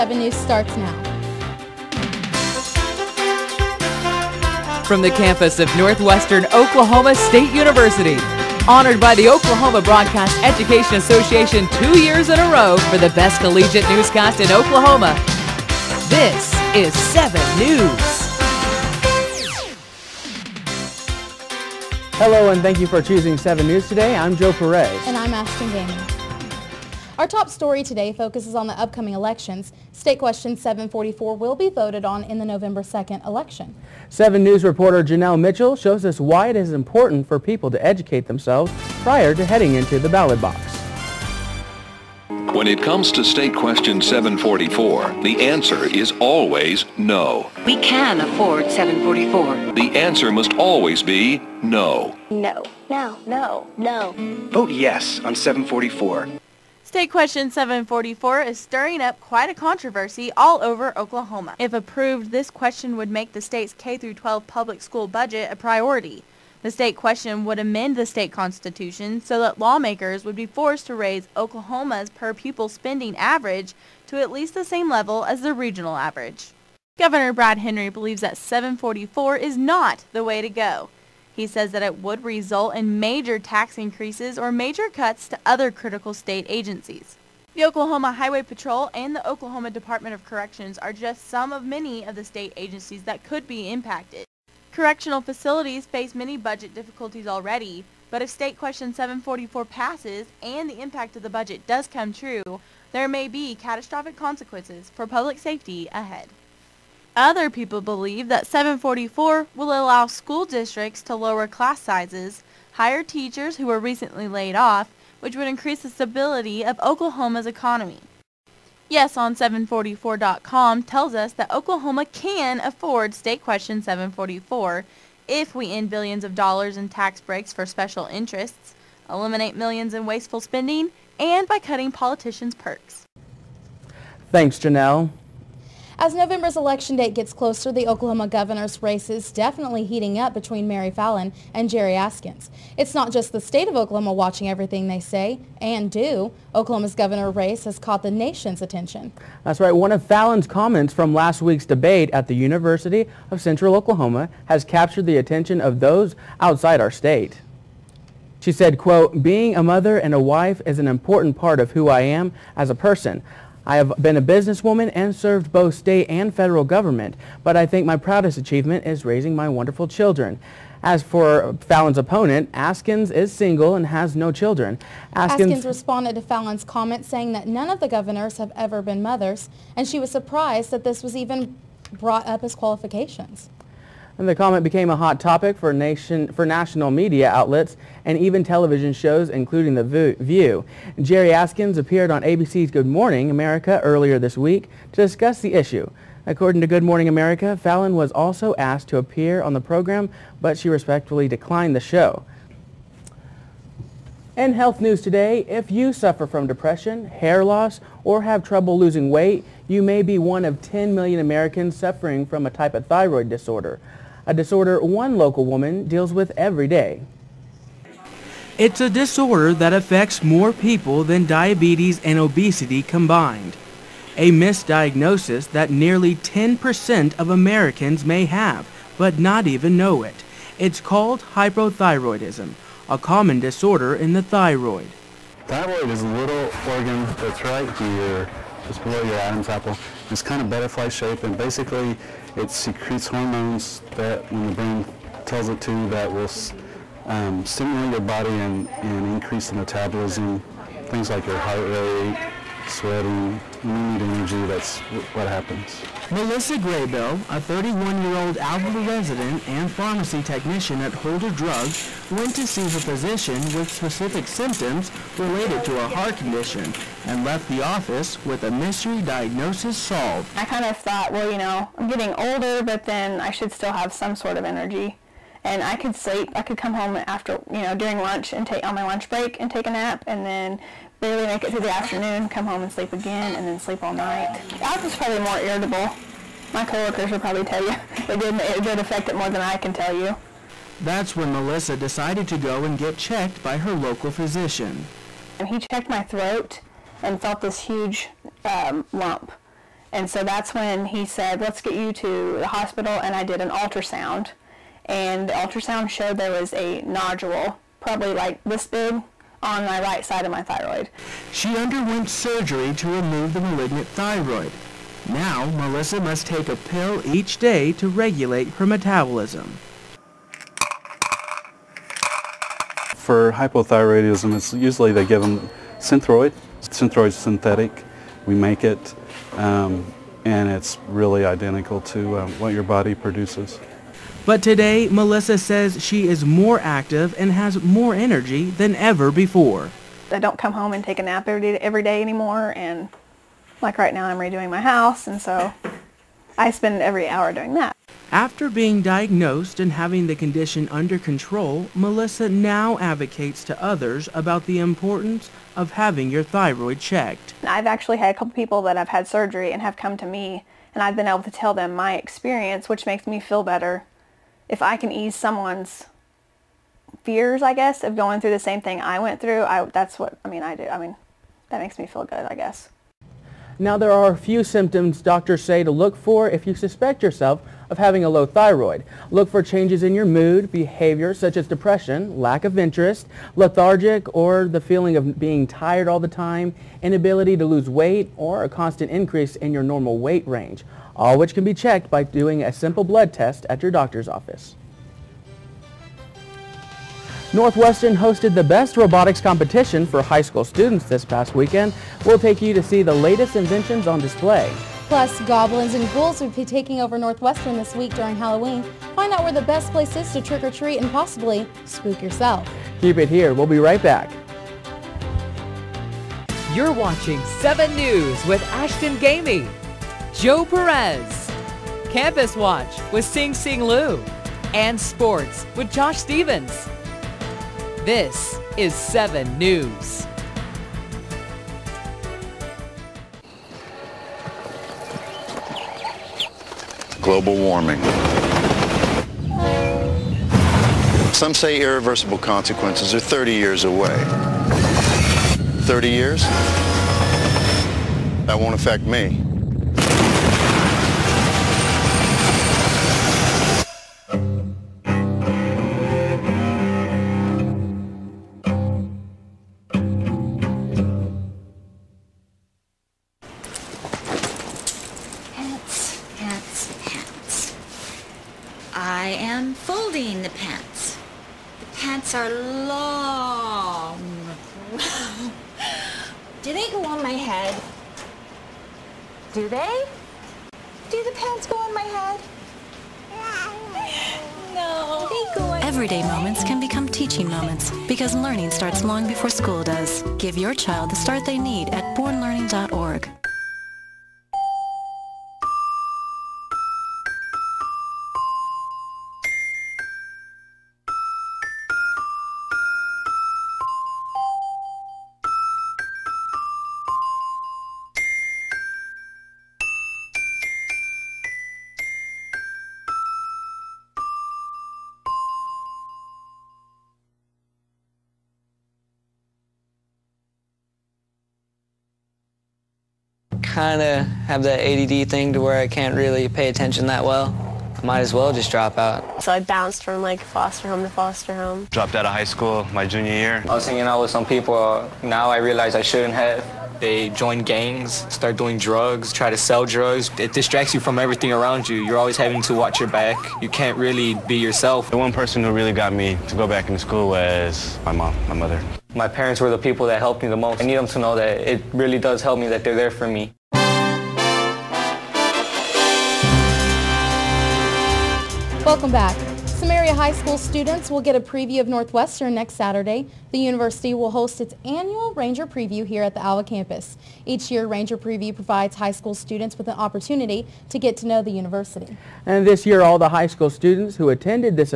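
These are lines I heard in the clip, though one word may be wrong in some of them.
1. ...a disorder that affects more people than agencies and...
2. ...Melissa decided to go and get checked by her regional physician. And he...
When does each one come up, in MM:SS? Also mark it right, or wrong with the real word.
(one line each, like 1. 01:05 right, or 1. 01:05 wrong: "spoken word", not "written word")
1. 03:38 wrong: "diabetes", not "agencies"
2. 04:51 wrong: "local", not "regional".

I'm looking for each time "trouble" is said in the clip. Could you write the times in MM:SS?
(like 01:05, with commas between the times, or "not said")
03:28.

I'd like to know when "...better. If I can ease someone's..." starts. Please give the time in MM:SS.
06:03.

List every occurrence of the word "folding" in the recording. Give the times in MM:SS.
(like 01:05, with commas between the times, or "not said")
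07:49.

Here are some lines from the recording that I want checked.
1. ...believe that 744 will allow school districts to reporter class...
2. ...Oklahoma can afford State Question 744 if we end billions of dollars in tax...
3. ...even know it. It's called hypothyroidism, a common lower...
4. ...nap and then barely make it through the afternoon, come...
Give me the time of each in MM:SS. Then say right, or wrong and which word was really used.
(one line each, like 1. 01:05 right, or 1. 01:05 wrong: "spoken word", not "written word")
1. 01:47 wrong: "lower", not "reporter"
2. 02:01 right
3. 03:49 wrong: "disorder", not "lower"
4. 04:39 right.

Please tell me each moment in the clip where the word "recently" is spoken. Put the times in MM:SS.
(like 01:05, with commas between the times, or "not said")
01:53.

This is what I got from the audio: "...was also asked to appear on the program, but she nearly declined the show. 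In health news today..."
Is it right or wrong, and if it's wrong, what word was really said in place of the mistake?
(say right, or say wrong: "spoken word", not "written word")
wrong: "respectfully", not "nearly".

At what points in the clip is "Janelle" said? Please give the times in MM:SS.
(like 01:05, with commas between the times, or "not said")
00:35, 02:14.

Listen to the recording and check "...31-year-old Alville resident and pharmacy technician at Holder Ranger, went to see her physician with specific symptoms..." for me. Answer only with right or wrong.
wrong.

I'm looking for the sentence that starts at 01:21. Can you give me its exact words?
He says that it would result in major tax increases or major cuts to other critical state agencies.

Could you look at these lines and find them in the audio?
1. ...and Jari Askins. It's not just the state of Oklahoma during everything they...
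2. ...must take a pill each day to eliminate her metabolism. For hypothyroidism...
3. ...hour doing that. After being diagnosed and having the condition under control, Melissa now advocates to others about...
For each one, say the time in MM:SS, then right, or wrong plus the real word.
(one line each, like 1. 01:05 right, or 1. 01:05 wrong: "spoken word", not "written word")
1. 02:21 wrong: "watching", not "during"
2. 05:15 wrong: "regulate", not "eliminate"
3. 05:47 right.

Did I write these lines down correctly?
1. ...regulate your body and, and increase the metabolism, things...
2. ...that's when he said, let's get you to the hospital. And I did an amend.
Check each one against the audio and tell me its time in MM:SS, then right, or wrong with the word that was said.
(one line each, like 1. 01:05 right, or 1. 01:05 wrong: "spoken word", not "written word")
1. 04:07 wrong: "stimulate", not "regulate"
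2. 05:00 wrong: "ultrasound", not "amend".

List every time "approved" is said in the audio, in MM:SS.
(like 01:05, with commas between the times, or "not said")
01:01.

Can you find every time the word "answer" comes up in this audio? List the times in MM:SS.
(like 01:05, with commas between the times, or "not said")
00:45, 00:49.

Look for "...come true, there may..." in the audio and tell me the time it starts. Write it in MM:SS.
01:41.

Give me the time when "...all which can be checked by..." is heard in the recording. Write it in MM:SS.
06:30.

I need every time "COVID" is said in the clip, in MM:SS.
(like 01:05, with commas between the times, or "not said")
not said.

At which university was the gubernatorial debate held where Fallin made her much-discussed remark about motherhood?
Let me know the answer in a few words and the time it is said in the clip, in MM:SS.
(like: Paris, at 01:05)
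University of Central Oklahoma, at 02:32.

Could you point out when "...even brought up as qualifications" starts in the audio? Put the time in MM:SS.
03:01.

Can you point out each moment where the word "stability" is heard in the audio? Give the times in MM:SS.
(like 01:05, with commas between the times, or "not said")
01:55.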